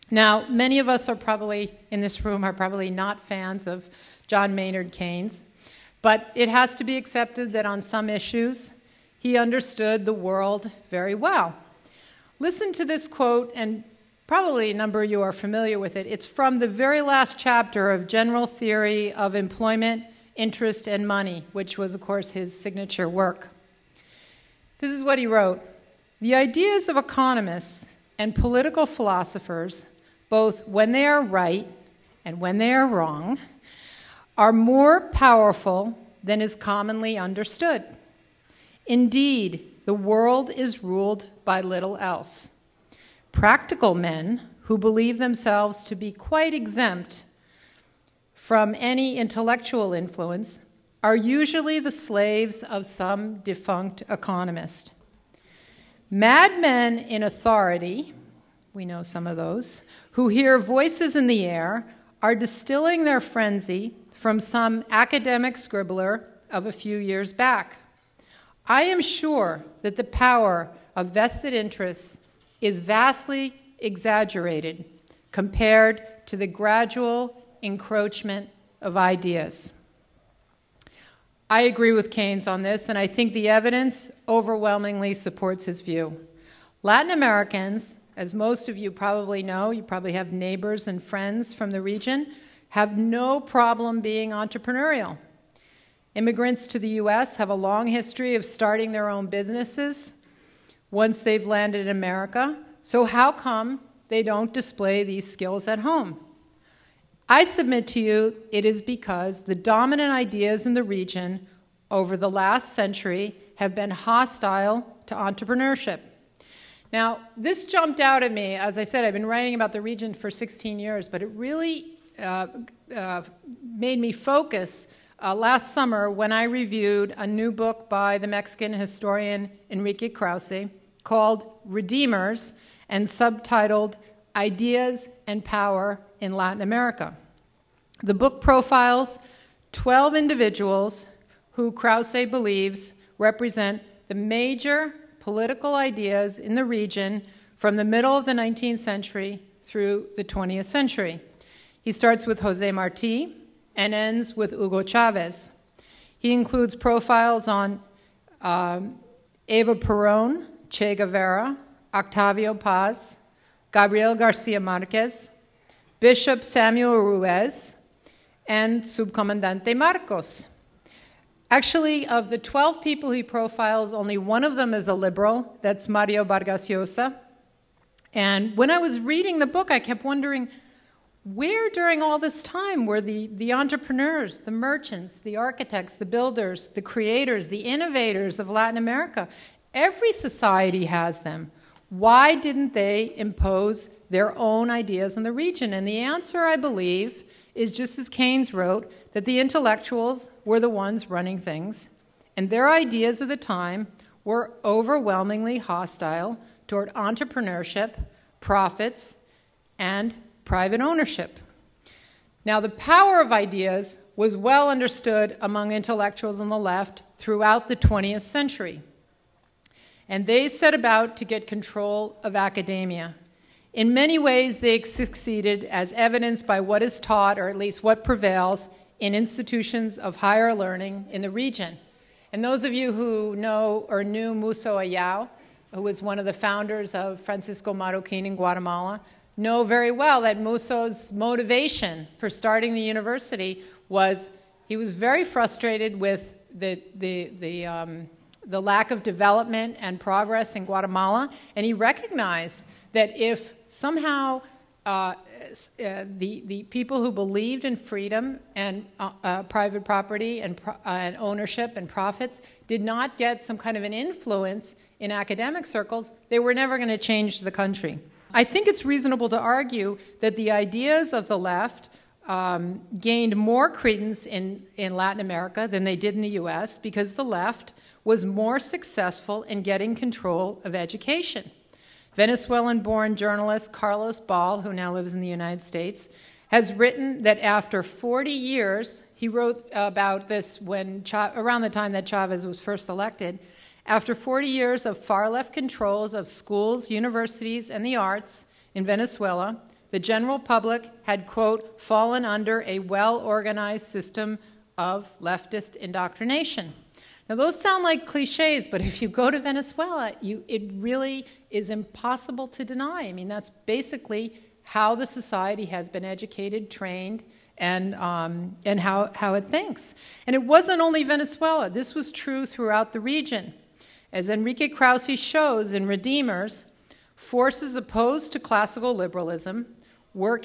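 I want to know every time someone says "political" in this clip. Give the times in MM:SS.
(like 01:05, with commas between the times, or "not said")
00:28, 02:25.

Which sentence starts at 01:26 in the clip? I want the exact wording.
Latin Americans as most of you probably know, you probably have neighbors and friends from the region, have no problem being entrepreneurial.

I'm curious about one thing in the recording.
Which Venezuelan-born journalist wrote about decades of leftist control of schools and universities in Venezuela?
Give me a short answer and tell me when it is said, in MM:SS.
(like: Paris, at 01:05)
Carlos Ball, at 04:43.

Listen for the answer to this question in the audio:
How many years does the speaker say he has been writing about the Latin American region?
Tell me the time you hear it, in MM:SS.
02:00.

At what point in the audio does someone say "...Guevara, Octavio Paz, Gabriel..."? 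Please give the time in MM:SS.
02:40.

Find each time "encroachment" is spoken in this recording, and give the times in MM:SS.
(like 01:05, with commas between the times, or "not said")
01:17.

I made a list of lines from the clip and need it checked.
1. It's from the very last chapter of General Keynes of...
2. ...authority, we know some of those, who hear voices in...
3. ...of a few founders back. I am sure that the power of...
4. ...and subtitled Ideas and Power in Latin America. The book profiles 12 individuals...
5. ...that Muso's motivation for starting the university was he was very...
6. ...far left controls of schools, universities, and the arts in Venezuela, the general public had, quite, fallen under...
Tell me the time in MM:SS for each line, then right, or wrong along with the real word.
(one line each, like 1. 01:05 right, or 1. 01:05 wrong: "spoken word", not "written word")
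1. 00:16 wrong: "Theory", not "Keynes"
2. 00:57 right
3. 01:06 wrong: "years", not "founders"
4. 02:12 right
5. 04:00 right
6. 04:54 wrong: "quote", not "quite".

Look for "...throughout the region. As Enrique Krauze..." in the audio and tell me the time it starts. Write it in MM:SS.
05:22.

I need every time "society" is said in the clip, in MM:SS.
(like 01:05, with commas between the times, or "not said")
03:10, 05:15.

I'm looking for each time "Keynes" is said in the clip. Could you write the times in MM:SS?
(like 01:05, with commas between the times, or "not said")
00:04, 01:22, 03:18.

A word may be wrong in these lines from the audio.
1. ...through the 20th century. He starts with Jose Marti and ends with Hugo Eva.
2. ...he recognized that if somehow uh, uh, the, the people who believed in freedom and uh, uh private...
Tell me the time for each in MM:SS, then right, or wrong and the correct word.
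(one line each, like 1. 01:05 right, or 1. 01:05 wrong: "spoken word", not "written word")
1. 02:29 wrong: "Chavez", not "Eva"
2. 04:11 right.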